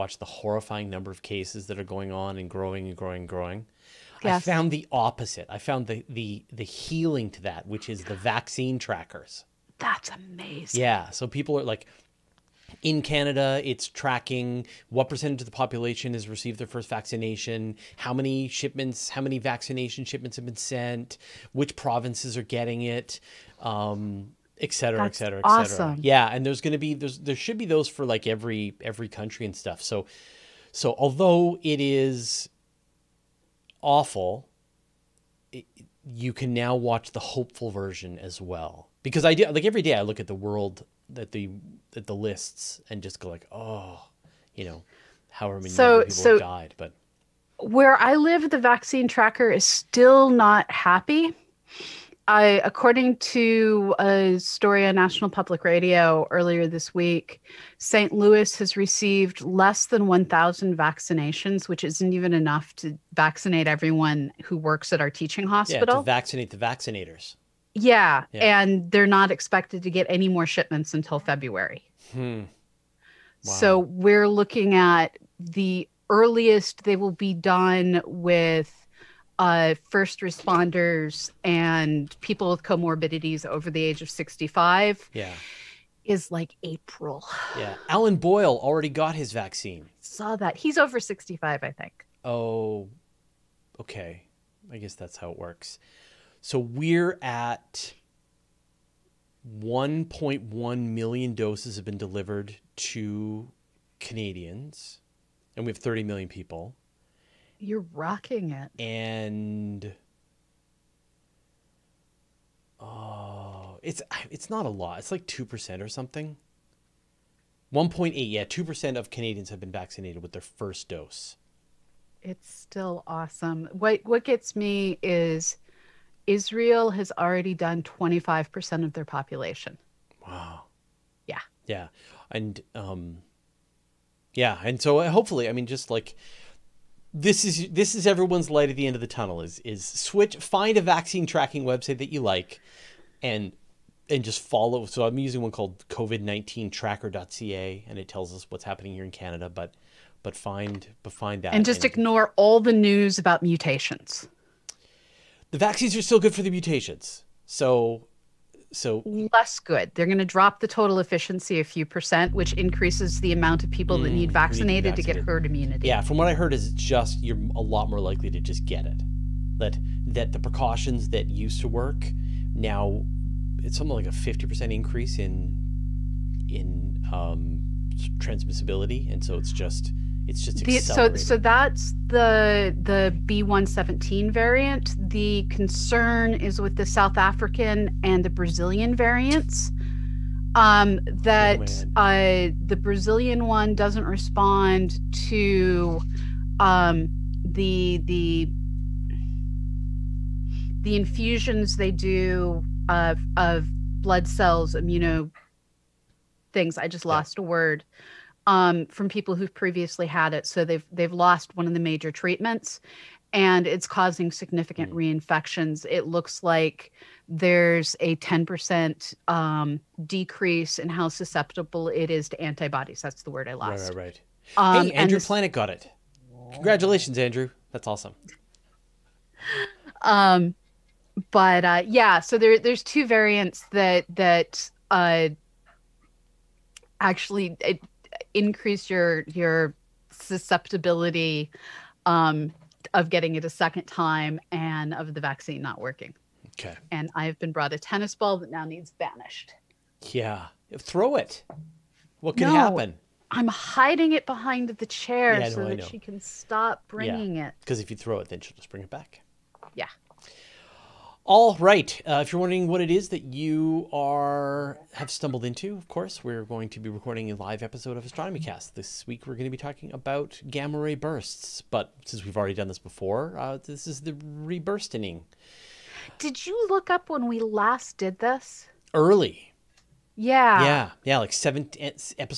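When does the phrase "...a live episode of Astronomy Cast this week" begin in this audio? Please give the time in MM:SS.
04:27.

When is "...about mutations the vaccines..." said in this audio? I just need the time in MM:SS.
02:33.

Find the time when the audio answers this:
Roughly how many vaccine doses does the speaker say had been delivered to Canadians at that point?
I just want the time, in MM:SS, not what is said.
01:39.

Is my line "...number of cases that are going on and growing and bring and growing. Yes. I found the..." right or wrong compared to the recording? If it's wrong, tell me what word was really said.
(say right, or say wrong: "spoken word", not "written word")
wrong: "growing", not "bring".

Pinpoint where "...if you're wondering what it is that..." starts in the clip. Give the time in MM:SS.
04:22.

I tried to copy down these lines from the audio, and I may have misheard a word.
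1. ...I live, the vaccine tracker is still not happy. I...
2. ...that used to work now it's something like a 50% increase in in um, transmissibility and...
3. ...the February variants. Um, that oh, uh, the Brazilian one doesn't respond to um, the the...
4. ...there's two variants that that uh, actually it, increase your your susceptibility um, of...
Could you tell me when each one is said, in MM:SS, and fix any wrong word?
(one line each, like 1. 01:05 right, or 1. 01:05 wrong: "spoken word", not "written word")
1. 00:48 right
2. 02:51 right
3. 03:08 wrong: "Brazilian", not "February"
4. 03:52 right.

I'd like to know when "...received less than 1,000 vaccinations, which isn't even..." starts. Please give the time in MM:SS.
00:58.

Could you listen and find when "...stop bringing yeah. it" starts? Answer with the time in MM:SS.
04:16.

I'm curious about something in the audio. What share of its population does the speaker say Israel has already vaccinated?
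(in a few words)
25%.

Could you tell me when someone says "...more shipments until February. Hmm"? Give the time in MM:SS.
01:10.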